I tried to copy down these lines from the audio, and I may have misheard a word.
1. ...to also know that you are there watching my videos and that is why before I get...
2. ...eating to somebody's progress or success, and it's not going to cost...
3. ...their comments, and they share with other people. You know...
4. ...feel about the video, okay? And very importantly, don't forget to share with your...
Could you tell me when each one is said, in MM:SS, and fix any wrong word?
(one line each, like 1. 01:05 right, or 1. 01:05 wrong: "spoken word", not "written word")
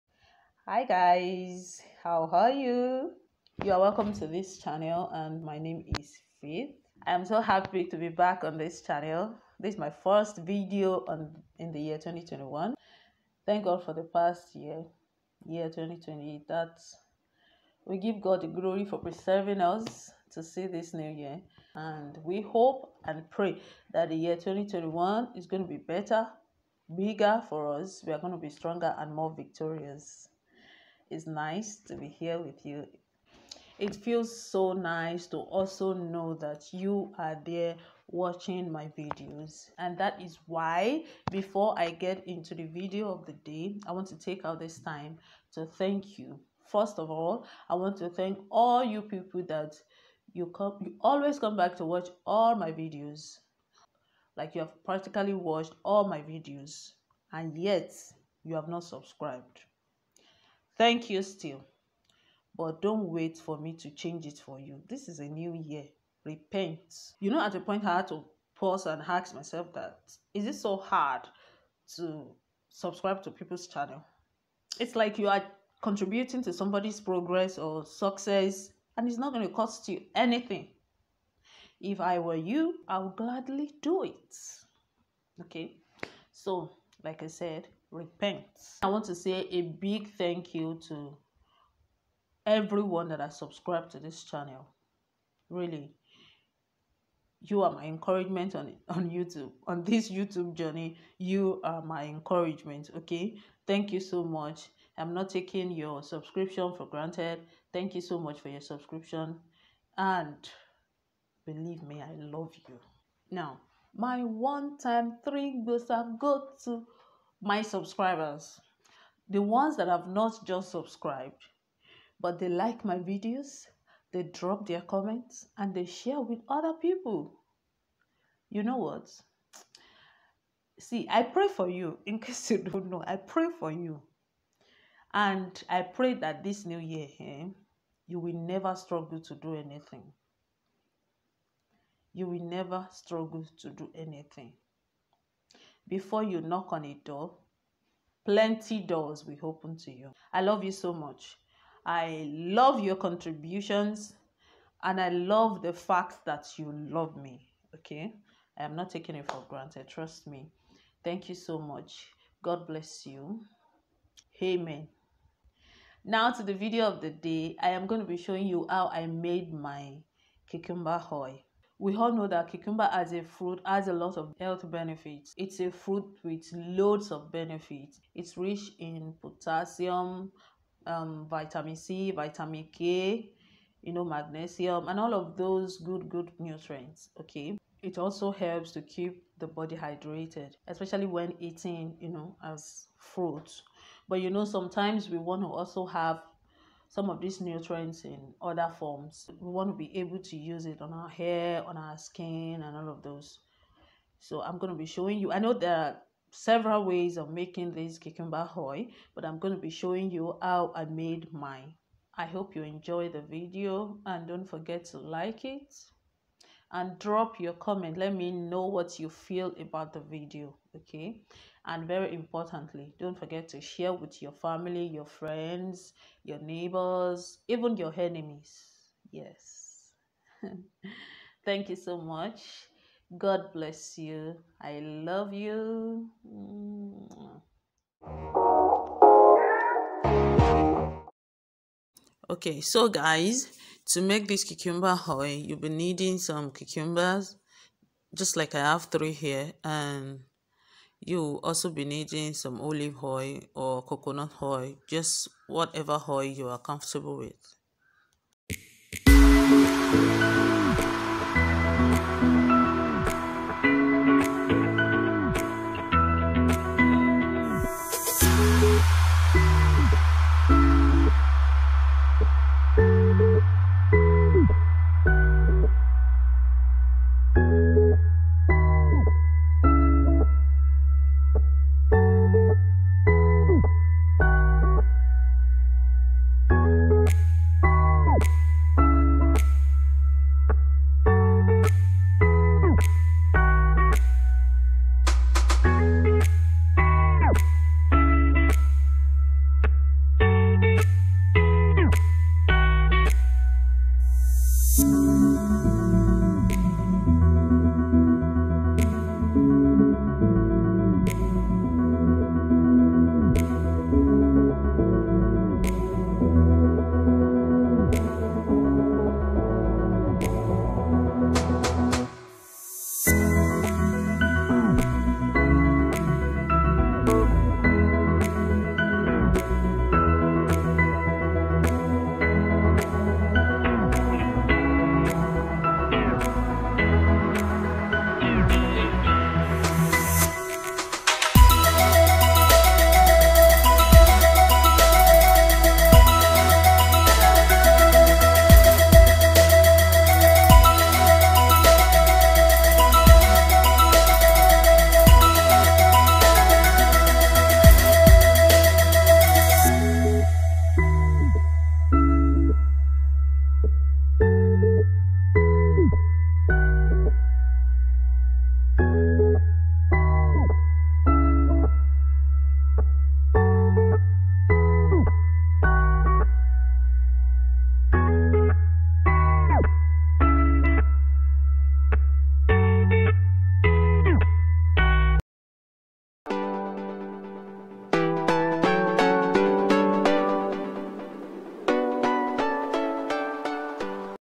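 1. 00:35 right
2. 01:15 wrong: "contributing", not "eating"
3. 02:04 right
4. 03:39 right.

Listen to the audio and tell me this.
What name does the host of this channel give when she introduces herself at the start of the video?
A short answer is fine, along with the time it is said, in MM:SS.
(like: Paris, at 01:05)
Faith, at 00:06.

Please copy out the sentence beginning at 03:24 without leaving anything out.
So I'm going to be showing you.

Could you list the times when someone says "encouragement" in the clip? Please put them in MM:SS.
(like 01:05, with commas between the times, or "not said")
01:37, 01:42.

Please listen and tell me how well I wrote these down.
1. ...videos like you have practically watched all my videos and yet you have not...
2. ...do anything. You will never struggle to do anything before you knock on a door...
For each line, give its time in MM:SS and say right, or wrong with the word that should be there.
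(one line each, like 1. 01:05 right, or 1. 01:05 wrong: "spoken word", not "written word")
1. 00:52 right
2. 02:19 right.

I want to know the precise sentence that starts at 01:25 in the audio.
Okay, so like I said, repent.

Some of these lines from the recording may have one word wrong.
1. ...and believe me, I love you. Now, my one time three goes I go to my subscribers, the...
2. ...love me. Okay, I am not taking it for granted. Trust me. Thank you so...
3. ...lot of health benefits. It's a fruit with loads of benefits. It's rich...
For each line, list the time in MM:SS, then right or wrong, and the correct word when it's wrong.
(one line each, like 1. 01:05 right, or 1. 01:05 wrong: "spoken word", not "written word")
1. 01:49 right
2. 02:36 right
3. 02:53 right.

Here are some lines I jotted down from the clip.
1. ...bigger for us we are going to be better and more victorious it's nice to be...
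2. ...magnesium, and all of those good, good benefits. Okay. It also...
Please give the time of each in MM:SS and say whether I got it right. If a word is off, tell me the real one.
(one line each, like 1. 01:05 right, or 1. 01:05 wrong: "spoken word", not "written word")
1. 00:26 wrong: "stronger", not "better"
2. 03:04 wrong: "nutrients", not "benefits".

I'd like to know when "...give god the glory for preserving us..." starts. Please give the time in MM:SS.
00:17.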